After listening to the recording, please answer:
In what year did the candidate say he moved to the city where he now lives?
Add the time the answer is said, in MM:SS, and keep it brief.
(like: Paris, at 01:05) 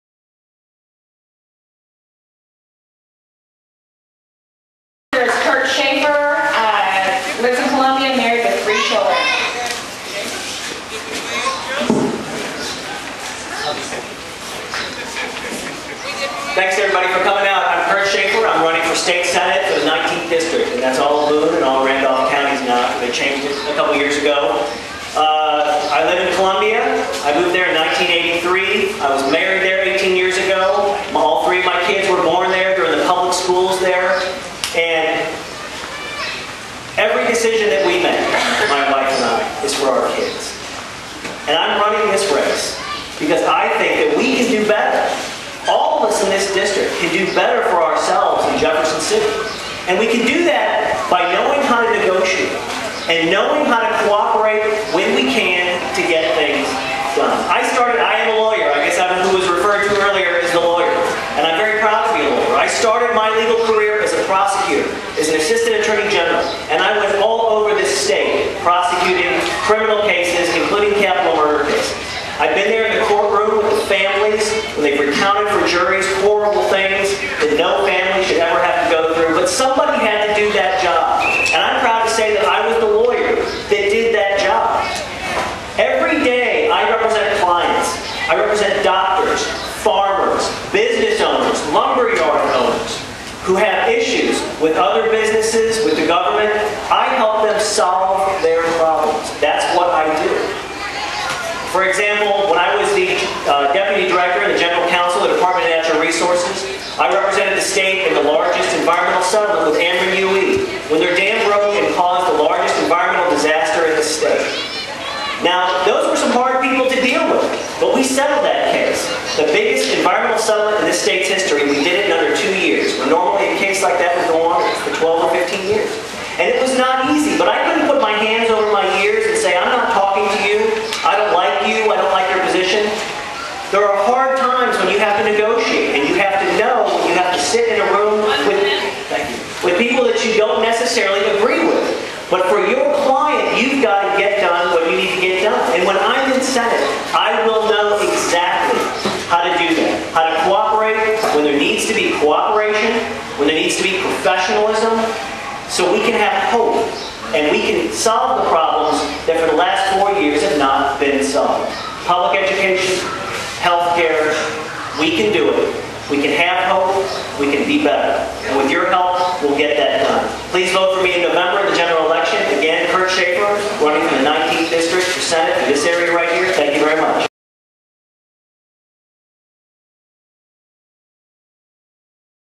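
1983, at 00:27.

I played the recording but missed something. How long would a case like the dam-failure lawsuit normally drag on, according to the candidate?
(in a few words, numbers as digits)
12 or 15 years.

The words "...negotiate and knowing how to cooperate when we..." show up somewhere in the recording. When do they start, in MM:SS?
00:51.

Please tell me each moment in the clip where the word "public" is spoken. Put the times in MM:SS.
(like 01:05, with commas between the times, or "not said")
00:33, 02:42.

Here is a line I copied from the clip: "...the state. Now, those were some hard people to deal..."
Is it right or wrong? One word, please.
right.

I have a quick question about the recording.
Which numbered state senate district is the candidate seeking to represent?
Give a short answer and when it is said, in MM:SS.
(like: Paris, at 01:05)
19th, at 00:19.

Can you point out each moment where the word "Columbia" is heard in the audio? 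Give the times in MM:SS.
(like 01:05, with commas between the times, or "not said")
00:26.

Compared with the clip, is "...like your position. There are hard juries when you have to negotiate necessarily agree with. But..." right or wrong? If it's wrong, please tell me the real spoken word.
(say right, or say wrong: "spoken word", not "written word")
wrong: "times", not "juries".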